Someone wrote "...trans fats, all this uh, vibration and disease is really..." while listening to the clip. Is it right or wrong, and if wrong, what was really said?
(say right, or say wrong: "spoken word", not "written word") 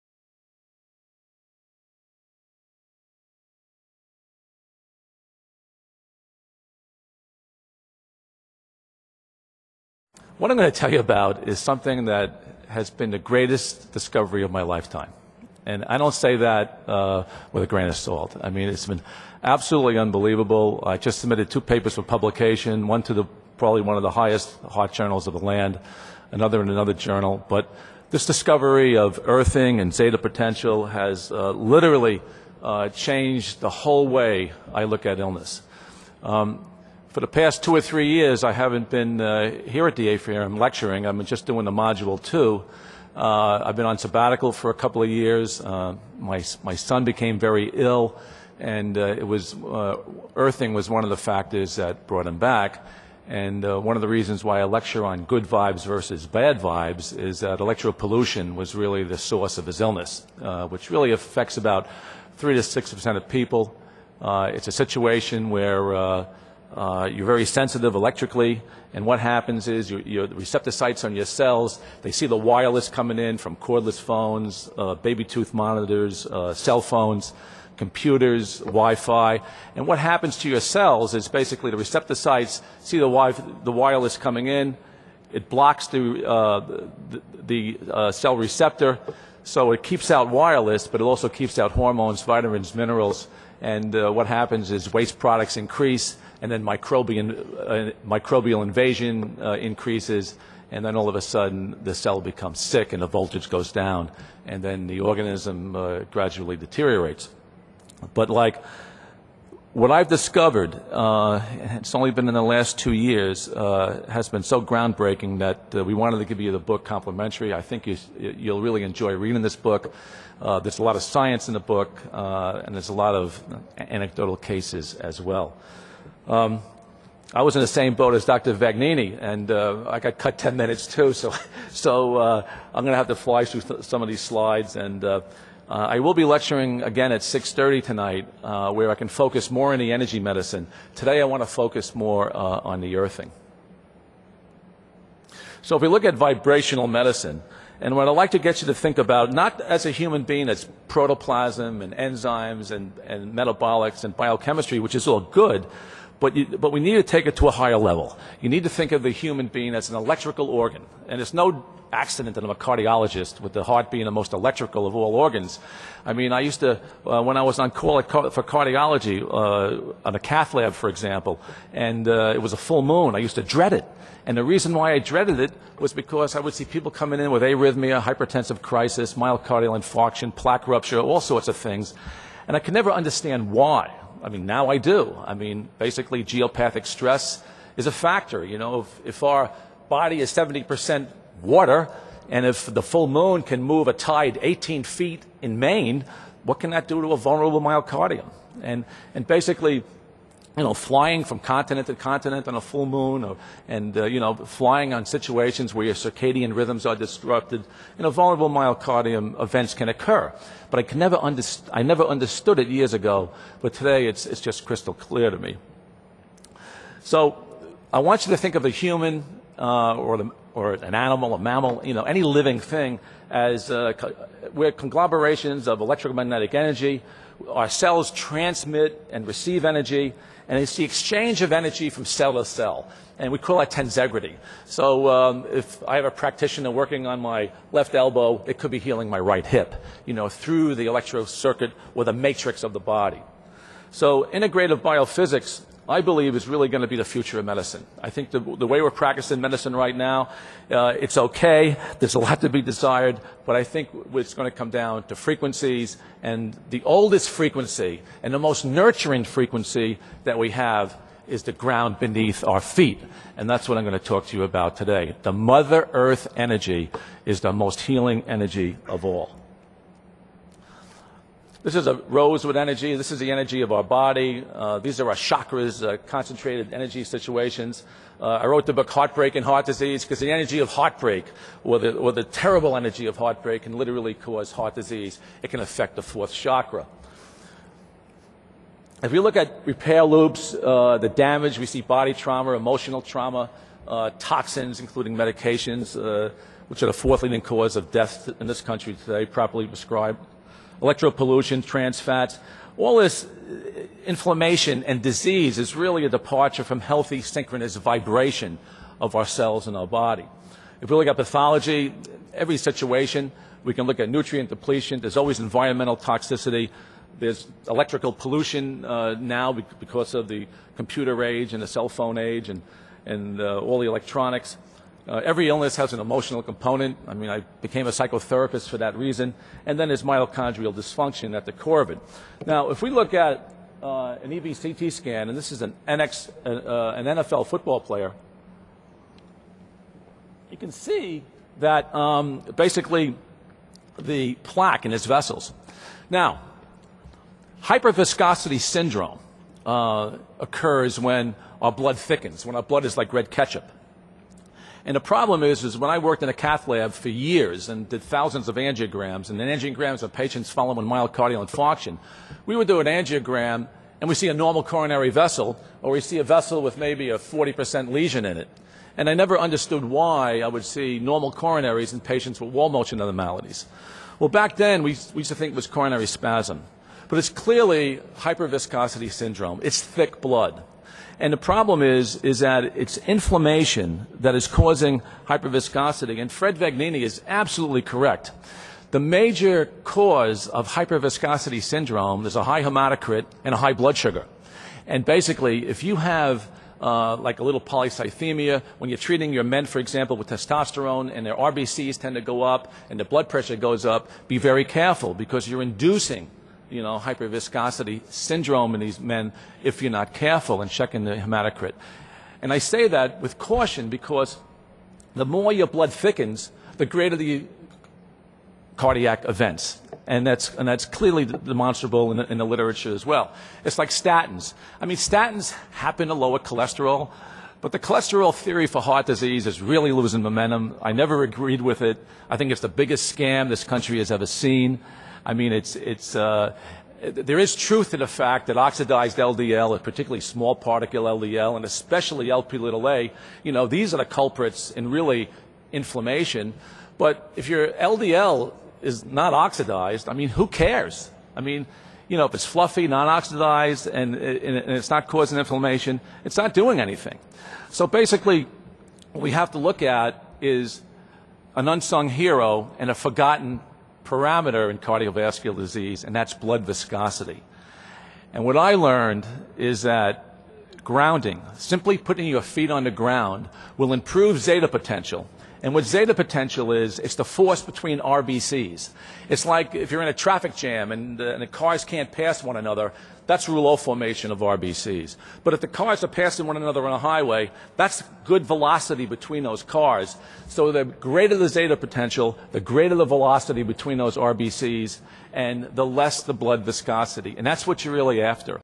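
wrong: "inflammation", not "vibration".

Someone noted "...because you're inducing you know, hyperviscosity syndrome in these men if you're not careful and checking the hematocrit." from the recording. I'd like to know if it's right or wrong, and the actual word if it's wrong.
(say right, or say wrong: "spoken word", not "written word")
right.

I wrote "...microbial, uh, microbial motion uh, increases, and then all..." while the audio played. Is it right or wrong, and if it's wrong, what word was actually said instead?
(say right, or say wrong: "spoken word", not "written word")
wrong: "invasion", not "motion".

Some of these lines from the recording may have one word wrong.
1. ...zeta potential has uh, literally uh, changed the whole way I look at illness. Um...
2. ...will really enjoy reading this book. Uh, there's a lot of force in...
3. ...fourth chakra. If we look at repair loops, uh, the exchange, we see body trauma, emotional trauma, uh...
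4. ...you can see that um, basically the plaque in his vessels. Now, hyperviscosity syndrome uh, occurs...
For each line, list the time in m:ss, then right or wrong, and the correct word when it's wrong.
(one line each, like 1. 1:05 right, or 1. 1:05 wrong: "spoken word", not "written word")
1. 0:29 right
2. 1:58 wrong: "science", not "force"
3. 4:46 wrong: "damage", not "exchange"
4. 5:40 right.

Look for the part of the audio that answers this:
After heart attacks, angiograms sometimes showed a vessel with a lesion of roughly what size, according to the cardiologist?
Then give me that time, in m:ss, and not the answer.
6:07.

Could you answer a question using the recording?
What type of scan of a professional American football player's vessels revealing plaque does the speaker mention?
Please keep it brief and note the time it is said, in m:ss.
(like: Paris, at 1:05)
EBCT scan, at 5:34.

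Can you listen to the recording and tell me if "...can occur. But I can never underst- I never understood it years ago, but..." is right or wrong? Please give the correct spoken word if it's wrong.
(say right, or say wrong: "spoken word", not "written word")
right.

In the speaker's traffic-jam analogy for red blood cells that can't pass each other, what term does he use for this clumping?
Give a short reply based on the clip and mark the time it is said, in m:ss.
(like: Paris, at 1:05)
rouleau formation, at 8:03.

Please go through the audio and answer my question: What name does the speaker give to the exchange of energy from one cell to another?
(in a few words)
tensegrity.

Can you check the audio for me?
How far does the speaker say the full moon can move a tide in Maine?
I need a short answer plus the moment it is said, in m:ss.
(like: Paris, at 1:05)
18 feet, at 3:14.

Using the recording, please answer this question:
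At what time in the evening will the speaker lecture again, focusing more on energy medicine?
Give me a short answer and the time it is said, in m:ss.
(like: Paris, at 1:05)
6:30, at 2:17.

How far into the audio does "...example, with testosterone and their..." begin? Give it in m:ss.
6:39.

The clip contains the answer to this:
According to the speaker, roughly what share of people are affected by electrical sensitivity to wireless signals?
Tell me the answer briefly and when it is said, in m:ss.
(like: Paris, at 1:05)
3 to 6 percent, at 1:02.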